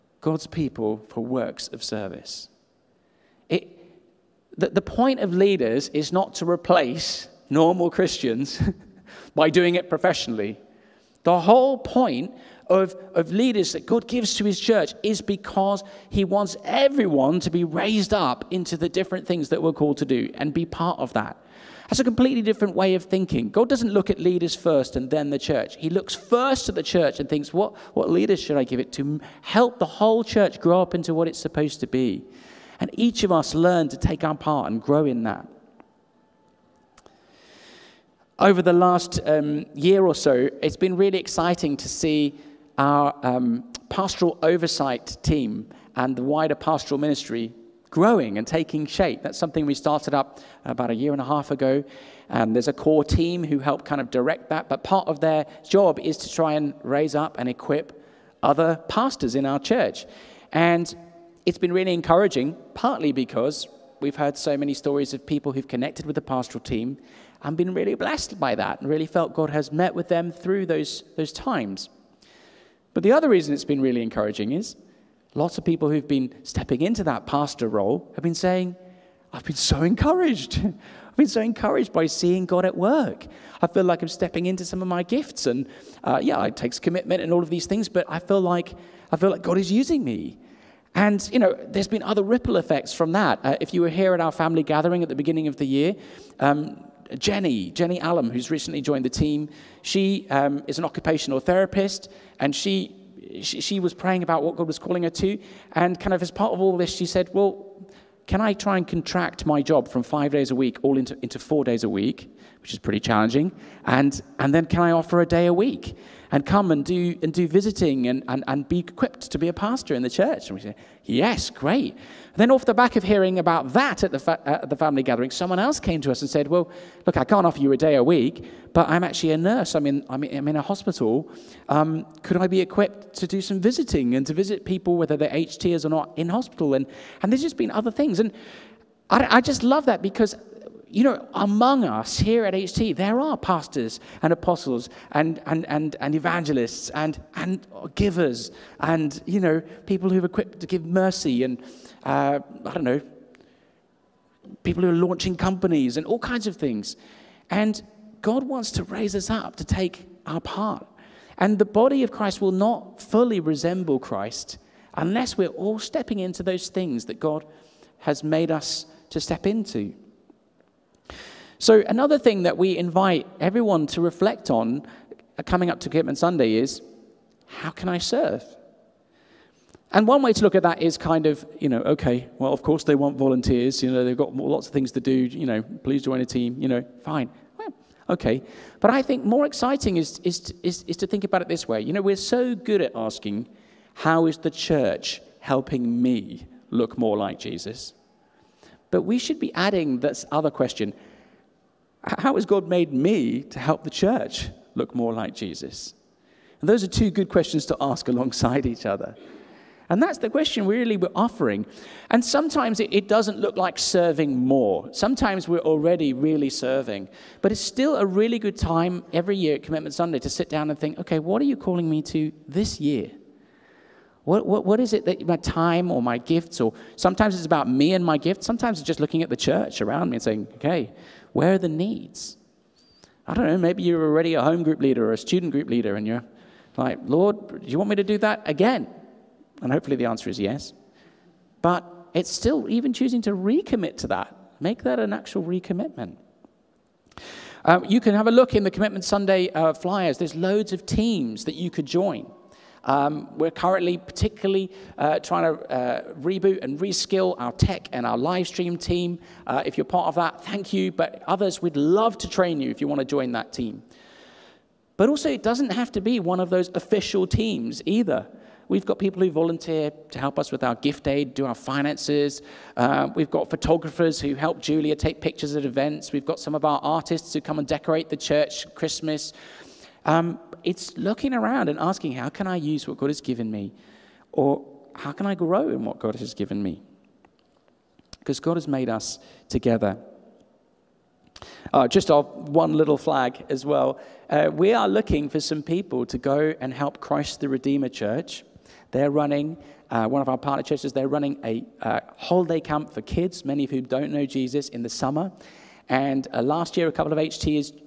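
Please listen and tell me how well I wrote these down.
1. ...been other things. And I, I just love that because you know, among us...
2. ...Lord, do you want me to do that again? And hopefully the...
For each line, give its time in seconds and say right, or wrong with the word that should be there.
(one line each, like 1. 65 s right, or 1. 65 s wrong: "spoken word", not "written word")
1. 137 s right
2. 237 s right.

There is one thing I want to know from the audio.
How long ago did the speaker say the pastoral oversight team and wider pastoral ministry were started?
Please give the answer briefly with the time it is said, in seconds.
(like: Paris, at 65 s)
A year and a half, at 50 s.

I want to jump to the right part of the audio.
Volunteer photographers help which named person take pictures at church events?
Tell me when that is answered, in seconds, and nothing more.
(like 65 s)
274 s.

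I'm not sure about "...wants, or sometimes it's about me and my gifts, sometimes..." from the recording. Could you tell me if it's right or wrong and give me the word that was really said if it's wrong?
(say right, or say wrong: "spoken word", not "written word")
wrong: "gifts", not "wants".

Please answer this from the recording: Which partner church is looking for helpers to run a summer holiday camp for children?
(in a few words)
Christ the Redeemer Church.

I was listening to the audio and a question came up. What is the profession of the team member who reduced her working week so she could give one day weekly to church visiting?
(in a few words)
Occupational therapist.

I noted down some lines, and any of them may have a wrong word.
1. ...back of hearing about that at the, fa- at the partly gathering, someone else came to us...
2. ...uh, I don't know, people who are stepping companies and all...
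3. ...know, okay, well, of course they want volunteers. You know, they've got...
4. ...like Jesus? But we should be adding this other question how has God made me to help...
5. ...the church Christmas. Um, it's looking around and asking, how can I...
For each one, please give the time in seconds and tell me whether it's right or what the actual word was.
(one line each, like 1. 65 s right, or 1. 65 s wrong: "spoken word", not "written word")
1. 122 s wrong: "family", not "partly"
2. 152 s wrong: "launching", not "stepping"
3. 181 s right
4. 197 s right
5. 278 s right.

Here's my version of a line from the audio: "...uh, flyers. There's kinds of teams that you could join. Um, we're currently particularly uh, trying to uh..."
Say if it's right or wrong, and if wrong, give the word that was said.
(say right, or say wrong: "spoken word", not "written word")
wrong: "loads", not "kinds".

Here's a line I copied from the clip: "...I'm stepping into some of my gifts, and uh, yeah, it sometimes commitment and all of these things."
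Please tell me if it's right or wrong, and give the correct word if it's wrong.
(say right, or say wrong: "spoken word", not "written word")
wrong: "takes", not "sometimes".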